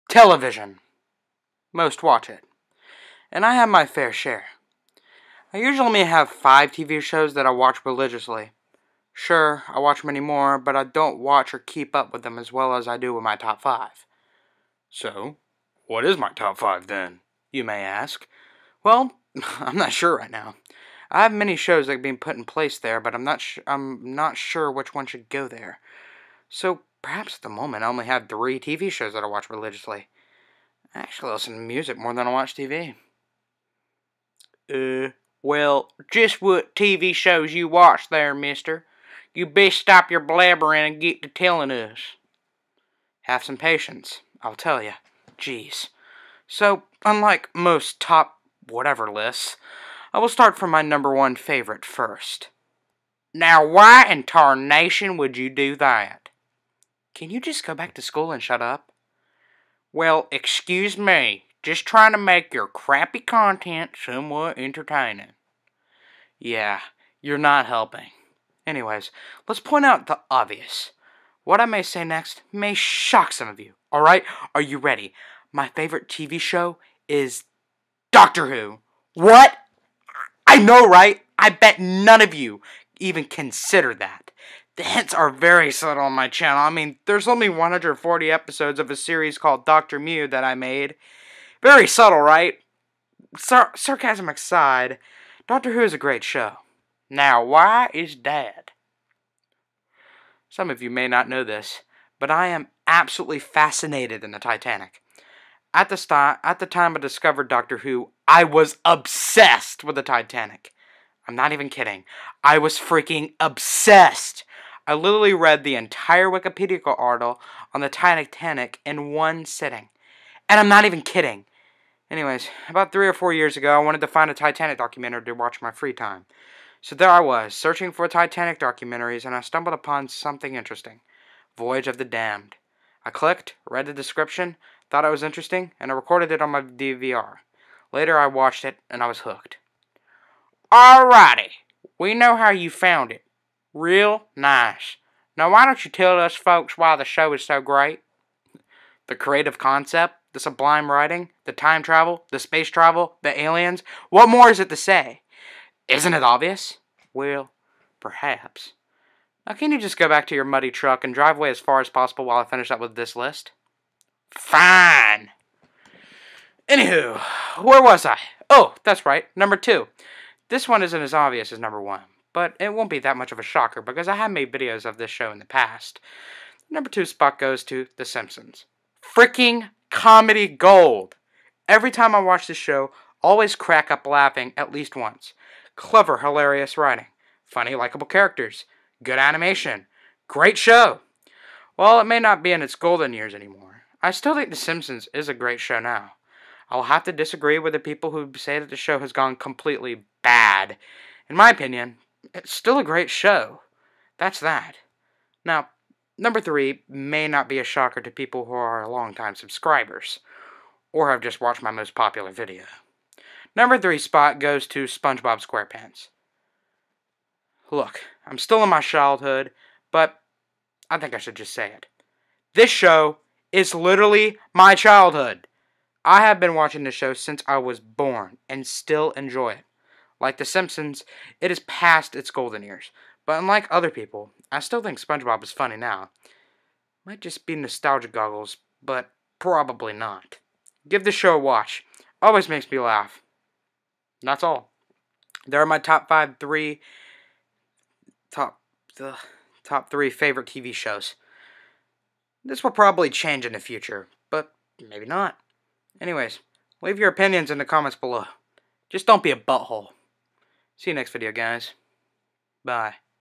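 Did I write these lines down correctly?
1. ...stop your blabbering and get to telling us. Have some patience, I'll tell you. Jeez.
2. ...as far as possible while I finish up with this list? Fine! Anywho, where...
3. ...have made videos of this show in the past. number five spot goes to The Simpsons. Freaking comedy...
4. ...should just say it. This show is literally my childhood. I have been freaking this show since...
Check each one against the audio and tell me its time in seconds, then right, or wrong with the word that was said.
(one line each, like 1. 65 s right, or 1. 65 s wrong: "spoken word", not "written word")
1. 39 s right
2. 161 s right
3. 174 s wrong: "two", not "five"
4. 221 s wrong: "watching", not "freaking".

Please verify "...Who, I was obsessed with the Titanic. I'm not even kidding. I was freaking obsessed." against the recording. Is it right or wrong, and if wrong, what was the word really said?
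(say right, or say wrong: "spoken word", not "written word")
right.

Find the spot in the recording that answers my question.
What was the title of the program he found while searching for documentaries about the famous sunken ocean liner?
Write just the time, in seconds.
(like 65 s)
131 s.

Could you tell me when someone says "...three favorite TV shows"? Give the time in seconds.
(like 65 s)
249 s.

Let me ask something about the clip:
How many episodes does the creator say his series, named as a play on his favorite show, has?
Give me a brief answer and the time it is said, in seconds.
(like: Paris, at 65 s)
140, at 87 s.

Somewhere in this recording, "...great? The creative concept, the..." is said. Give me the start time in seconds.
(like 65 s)
147 s.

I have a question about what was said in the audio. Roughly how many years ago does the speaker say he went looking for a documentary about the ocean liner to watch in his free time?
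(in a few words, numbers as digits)
3 or 4.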